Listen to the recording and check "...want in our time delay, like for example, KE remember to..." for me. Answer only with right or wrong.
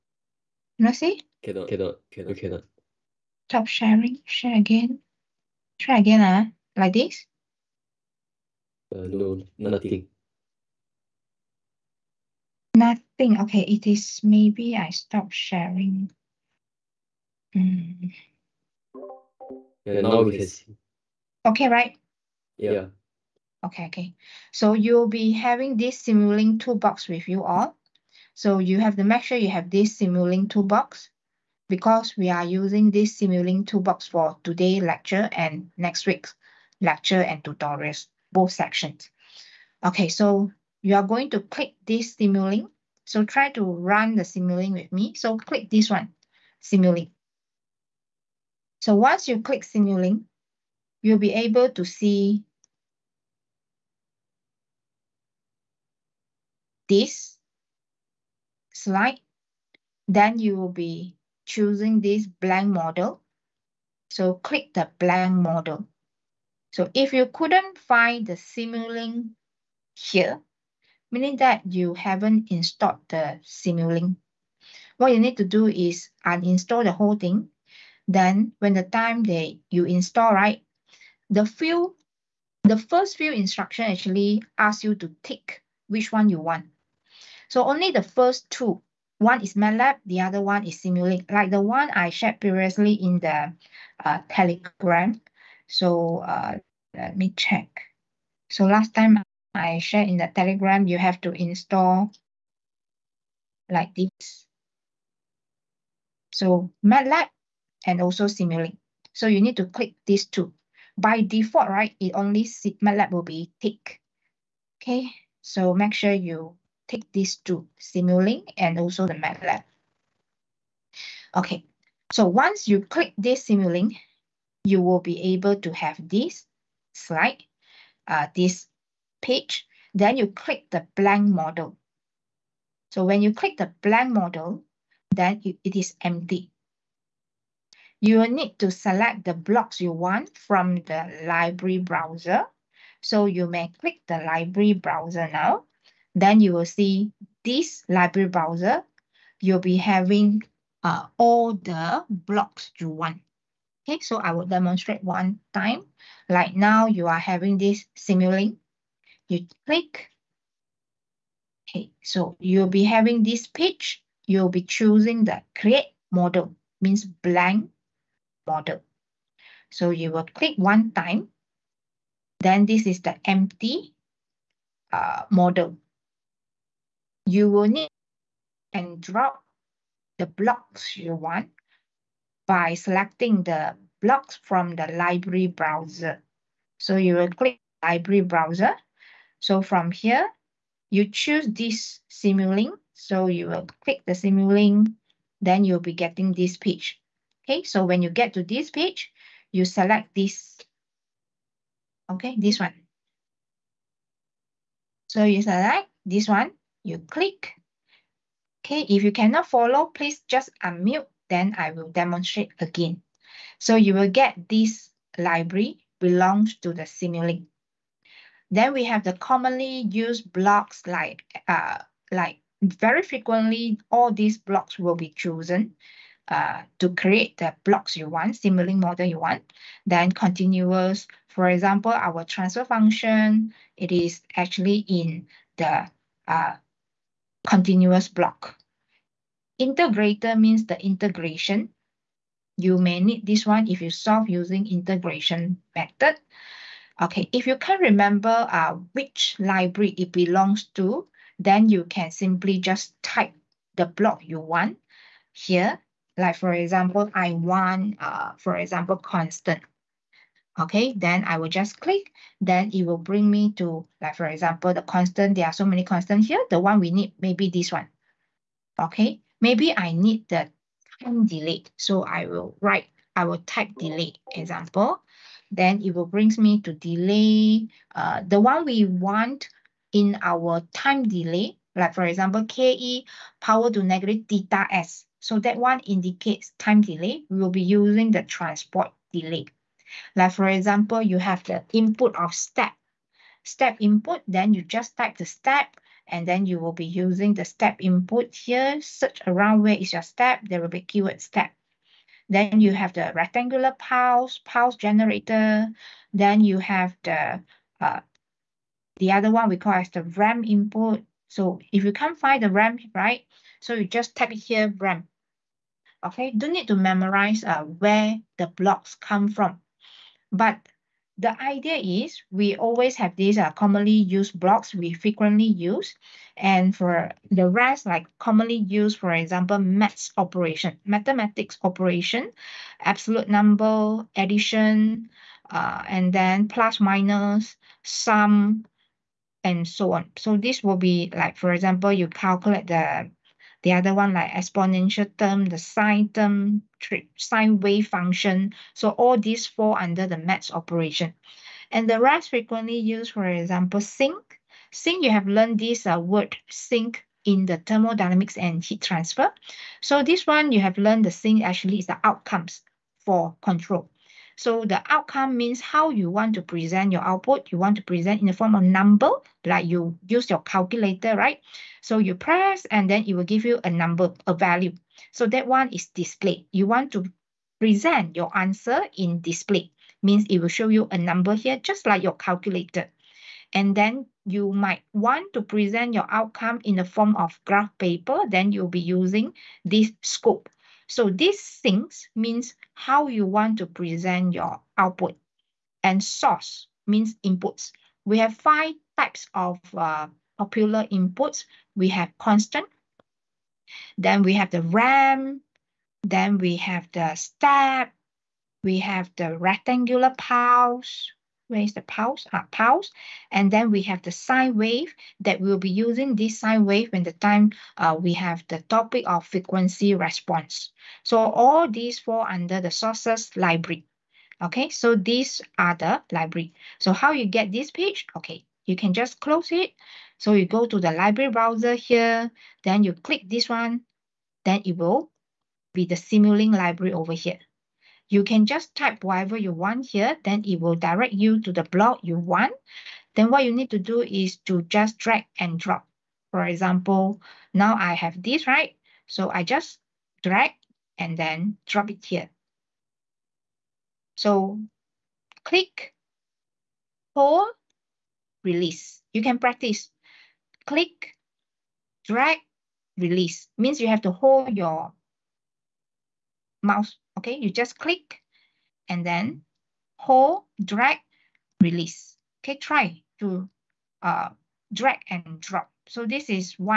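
wrong.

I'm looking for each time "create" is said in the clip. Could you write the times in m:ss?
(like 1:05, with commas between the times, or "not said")
2:45, 3:46.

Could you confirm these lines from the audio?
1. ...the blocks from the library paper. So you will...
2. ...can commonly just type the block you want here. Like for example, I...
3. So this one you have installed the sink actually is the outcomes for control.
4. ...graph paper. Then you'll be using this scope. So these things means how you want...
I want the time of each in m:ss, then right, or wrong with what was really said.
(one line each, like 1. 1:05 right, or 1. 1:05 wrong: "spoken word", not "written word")
1. 3:03 wrong: "browser", not "paper"
2. 4:11 wrong: "simply", not "commonly"
3. 5:59 wrong: "learned", not "installed"
4. 6:27 right.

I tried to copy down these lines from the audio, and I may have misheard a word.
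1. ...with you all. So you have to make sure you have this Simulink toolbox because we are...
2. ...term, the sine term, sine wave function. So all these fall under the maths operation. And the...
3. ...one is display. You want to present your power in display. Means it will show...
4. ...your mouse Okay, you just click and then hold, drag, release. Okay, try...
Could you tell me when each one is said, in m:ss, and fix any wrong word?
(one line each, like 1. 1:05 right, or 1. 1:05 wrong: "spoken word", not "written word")
1. 0:27 right
2. 5:45 right
3. 6:15 wrong: "answer", not "power"
4. 7:44 right.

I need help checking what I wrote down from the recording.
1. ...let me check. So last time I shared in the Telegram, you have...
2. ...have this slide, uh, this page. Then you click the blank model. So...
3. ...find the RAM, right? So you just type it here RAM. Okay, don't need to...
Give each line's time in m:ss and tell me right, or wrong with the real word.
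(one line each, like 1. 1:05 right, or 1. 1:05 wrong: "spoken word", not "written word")
1. 1:36 right
2. 2:05 right
3. 5:12 right.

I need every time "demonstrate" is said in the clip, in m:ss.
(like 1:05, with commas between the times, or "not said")
2:34, 3:31.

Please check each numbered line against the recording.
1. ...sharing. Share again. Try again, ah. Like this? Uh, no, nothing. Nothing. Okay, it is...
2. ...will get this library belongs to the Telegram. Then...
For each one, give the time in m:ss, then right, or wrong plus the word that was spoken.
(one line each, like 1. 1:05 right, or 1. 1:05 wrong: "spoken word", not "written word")
1. 0:03 right
2. 3:33 wrong: "Simulink", not "Telegram".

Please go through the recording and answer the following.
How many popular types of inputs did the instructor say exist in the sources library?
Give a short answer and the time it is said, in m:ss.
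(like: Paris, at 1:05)
5, at 6:38.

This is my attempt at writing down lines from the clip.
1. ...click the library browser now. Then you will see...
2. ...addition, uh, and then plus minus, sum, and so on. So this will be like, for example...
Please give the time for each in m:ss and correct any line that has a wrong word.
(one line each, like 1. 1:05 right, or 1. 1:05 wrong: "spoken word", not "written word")
1. 2:23 right
2. 5:34 right.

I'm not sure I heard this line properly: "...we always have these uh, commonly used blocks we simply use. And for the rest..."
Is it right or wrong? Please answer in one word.
wrong.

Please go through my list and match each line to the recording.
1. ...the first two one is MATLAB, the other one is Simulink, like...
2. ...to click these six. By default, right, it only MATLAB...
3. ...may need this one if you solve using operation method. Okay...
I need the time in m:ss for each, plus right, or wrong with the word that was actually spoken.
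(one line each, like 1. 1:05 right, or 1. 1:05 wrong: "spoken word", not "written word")
1. 1:27 right
2. 1:49 wrong: "two", not "six"
3. 4:02 wrong: "integration", not "operation".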